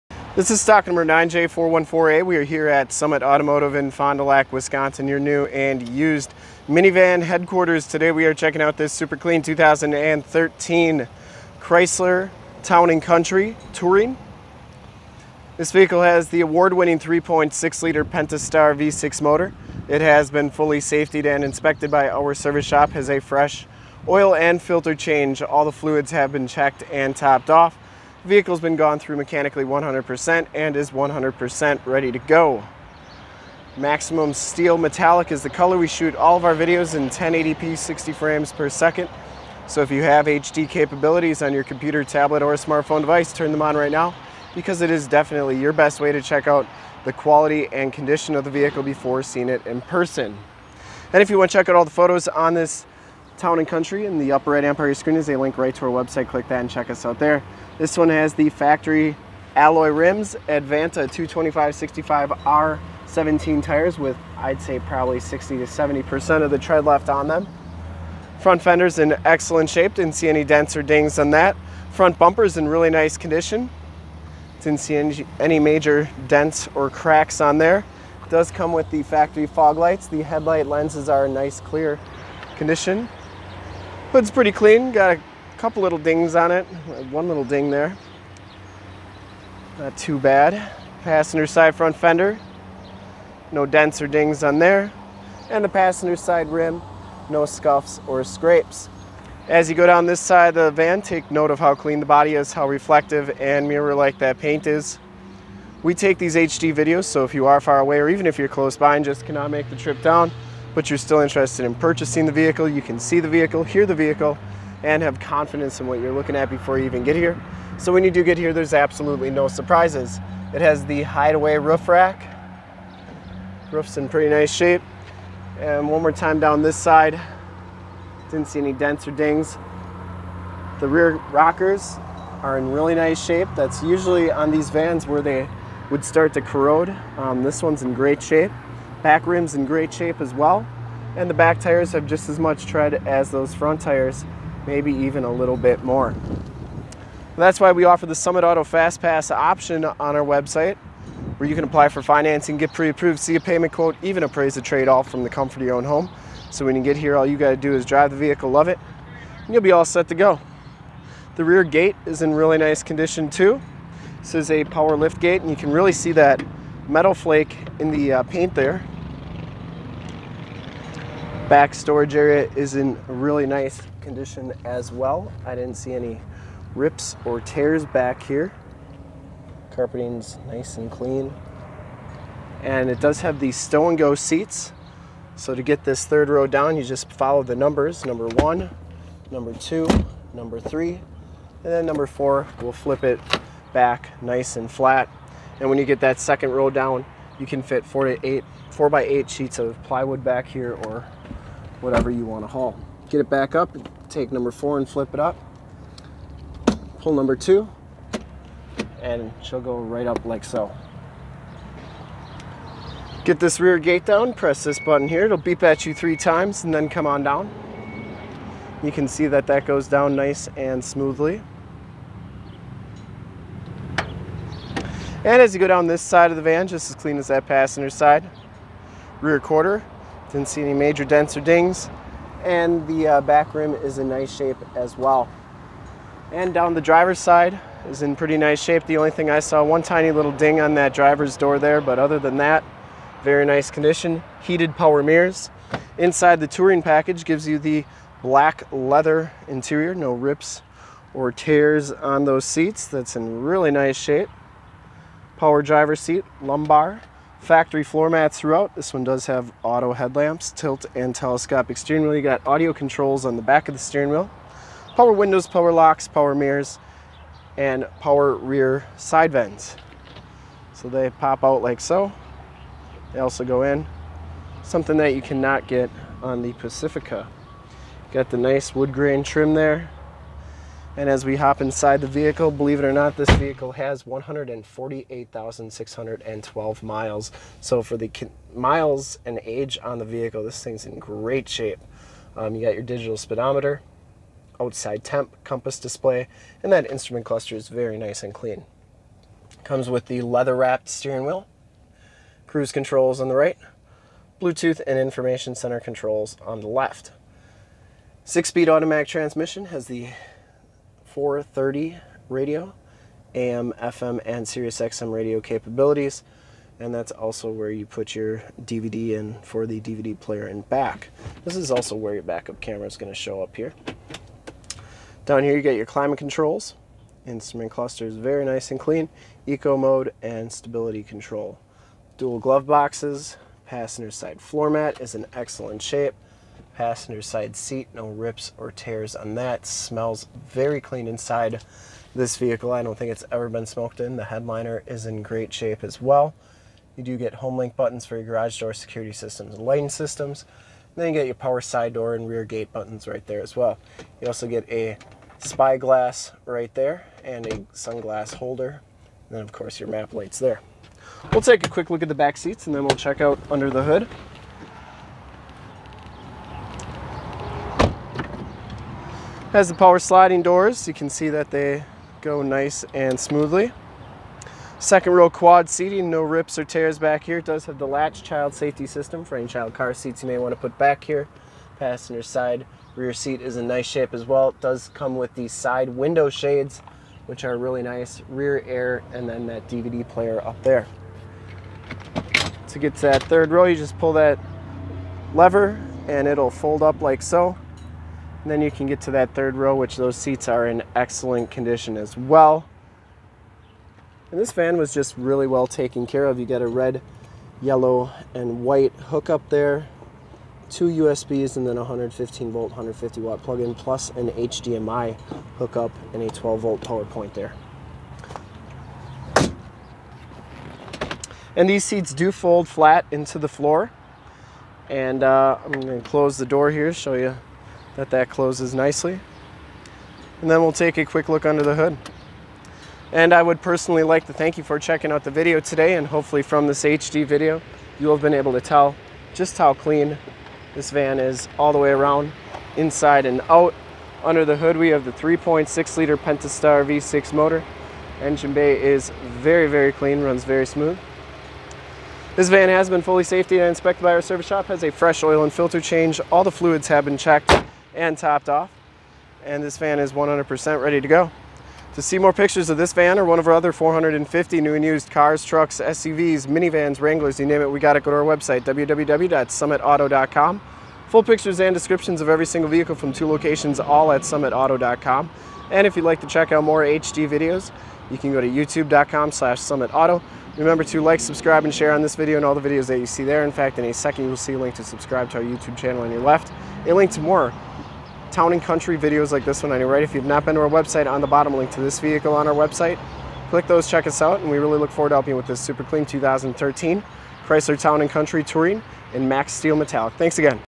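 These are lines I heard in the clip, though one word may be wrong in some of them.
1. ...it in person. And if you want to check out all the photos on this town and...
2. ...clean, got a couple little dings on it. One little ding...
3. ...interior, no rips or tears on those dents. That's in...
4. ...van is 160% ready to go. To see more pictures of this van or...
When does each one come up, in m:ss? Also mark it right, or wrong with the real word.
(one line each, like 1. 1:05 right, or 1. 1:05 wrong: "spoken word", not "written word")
1. 0:49 right
2. 1:24 right
3. 4:09 wrong: "seats", not "dents"
4. 7:39 wrong: "100", not "160".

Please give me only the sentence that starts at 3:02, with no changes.
And it does have these stow and go seats.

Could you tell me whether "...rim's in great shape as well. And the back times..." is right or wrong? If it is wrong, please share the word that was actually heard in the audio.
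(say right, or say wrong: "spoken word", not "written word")
wrong: "tires", not "times".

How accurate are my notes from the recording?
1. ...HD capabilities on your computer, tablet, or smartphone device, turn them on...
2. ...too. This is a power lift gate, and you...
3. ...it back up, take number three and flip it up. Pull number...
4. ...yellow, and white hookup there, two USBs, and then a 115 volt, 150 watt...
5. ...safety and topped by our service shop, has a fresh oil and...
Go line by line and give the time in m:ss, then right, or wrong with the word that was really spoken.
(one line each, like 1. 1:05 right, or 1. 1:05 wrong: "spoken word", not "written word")
1. 0:40 right
2. 2:43 right
3. 3:23 wrong: "four", not "three"
4. 6:47 right
5. 7:33 wrong: "inspected", not "topped".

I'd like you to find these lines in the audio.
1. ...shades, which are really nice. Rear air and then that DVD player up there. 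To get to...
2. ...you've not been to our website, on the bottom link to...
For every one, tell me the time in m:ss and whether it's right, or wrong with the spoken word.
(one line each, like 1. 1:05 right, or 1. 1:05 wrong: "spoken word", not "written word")
1. 6:26 right
2. 8:10 right.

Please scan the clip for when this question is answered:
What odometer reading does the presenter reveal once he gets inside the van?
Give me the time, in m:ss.
4:44.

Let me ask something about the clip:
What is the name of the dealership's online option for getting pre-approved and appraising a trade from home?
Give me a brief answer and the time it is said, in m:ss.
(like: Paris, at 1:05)
Summit Auto Fast Pass, at 2:28.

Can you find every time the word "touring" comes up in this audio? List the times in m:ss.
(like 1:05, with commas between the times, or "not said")
0:13, 4:06, 8:18.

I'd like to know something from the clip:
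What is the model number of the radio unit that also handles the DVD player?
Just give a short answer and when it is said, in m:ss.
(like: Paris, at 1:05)
430, at 5:11.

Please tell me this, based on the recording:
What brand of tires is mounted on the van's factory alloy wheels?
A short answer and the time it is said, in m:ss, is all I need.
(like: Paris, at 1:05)
Advanta, at 1:00.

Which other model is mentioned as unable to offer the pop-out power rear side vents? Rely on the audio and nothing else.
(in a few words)
Pacifica.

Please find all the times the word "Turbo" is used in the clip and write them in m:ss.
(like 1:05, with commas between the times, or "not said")
not said.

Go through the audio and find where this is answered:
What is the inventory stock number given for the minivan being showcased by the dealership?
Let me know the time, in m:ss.
0:01.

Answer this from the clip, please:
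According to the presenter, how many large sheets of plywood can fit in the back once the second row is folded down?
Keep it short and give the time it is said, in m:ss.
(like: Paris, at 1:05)
4 to 8, at 3:17.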